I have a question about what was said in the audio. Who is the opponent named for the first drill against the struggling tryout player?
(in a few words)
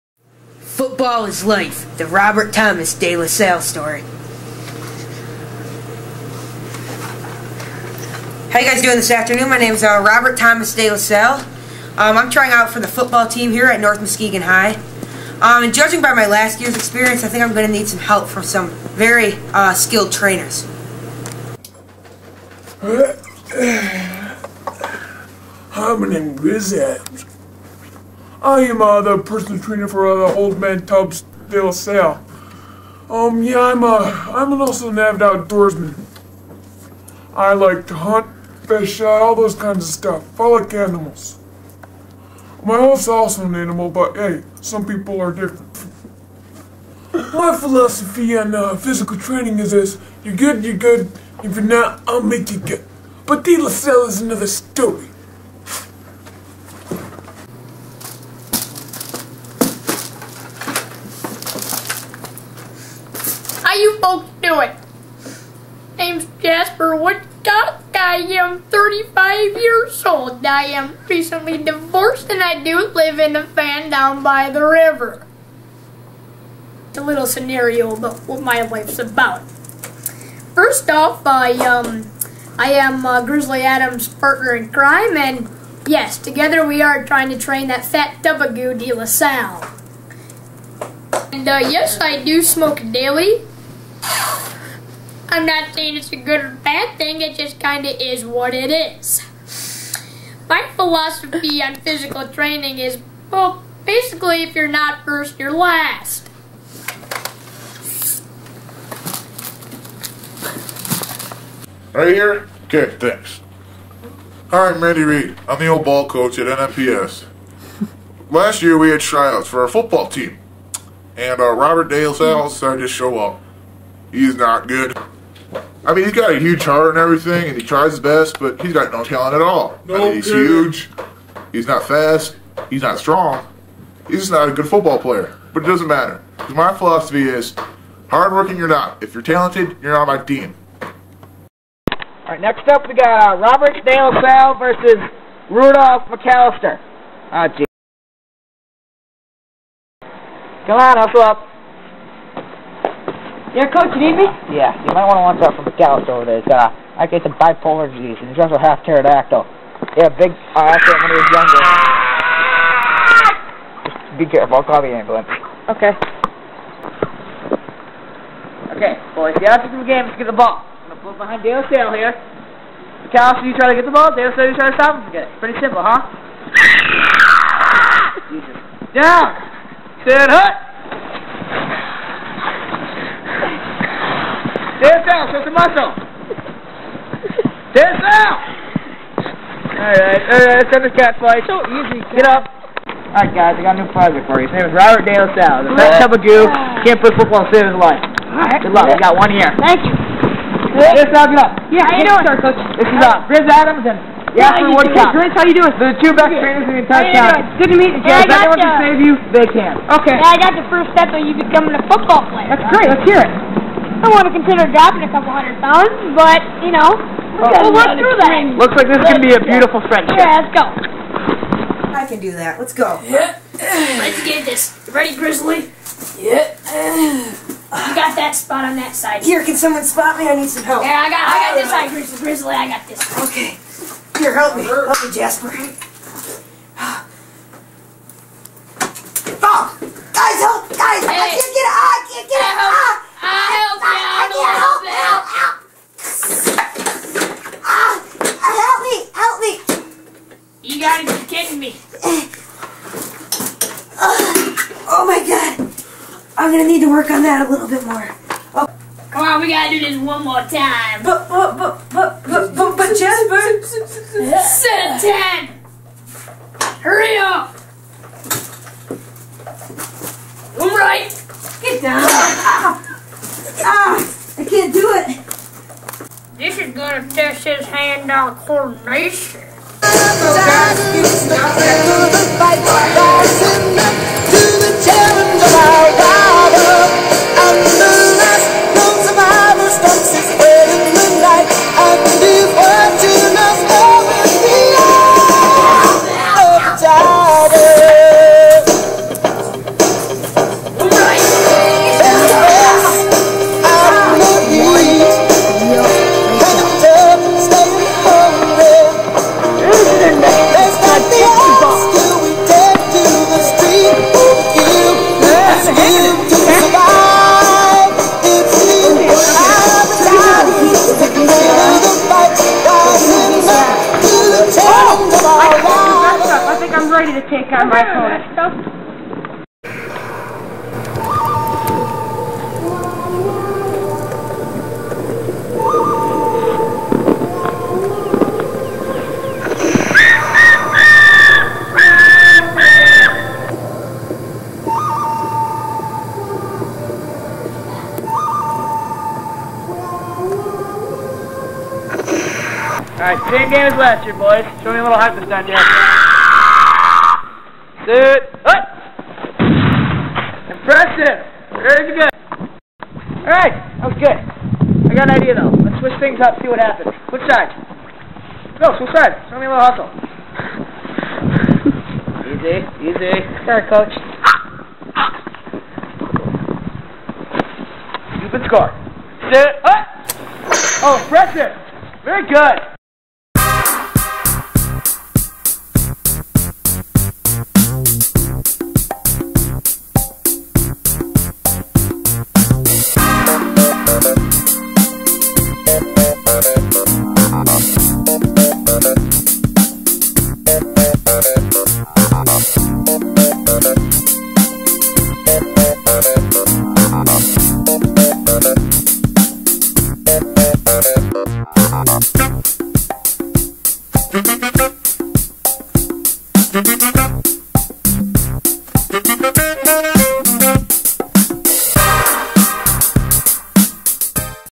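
Rudolph McAllister.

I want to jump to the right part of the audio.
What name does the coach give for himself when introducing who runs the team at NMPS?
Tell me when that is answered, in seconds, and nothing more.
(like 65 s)
114 s.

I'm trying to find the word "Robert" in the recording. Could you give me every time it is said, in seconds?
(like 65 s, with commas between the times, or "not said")
2 s, 10 s, 121 s, 143 s, 194 s.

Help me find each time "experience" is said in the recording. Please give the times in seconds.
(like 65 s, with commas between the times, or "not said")
16 s.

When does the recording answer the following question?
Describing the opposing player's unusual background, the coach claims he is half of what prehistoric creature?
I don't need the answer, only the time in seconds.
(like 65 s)
158 s.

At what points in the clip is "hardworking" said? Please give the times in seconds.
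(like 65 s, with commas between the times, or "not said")
138 s.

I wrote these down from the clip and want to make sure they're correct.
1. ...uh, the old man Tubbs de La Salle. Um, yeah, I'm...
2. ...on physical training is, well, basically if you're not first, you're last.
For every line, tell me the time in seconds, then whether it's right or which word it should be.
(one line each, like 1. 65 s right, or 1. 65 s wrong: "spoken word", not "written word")
1. 30 s right
2. 101 s right.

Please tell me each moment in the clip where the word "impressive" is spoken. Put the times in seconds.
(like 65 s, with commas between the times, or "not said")
360 s, 381 s.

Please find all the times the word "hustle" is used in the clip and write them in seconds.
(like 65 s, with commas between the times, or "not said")
150 s, 369 s.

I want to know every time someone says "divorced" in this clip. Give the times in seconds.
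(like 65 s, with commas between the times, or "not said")
71 s.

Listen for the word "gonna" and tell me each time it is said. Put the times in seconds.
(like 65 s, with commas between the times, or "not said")
256 s, 276 s.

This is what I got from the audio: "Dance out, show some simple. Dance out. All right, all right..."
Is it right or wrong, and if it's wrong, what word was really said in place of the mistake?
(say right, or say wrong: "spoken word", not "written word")
wrong: "muscle", not "simple".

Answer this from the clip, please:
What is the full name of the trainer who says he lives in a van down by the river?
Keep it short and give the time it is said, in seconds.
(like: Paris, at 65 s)
Jasper Woodcock, at 66 s.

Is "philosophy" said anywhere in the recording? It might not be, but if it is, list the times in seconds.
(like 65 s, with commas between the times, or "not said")
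47 s, 100 s, 136 s.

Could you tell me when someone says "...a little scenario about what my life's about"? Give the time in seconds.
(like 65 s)
76 s.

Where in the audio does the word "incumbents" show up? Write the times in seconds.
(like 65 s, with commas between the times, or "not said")
not said.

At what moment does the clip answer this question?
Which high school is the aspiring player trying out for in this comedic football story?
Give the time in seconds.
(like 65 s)
13 s.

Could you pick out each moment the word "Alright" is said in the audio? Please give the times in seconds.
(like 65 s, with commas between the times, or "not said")
114 s, 353 s, 363 s.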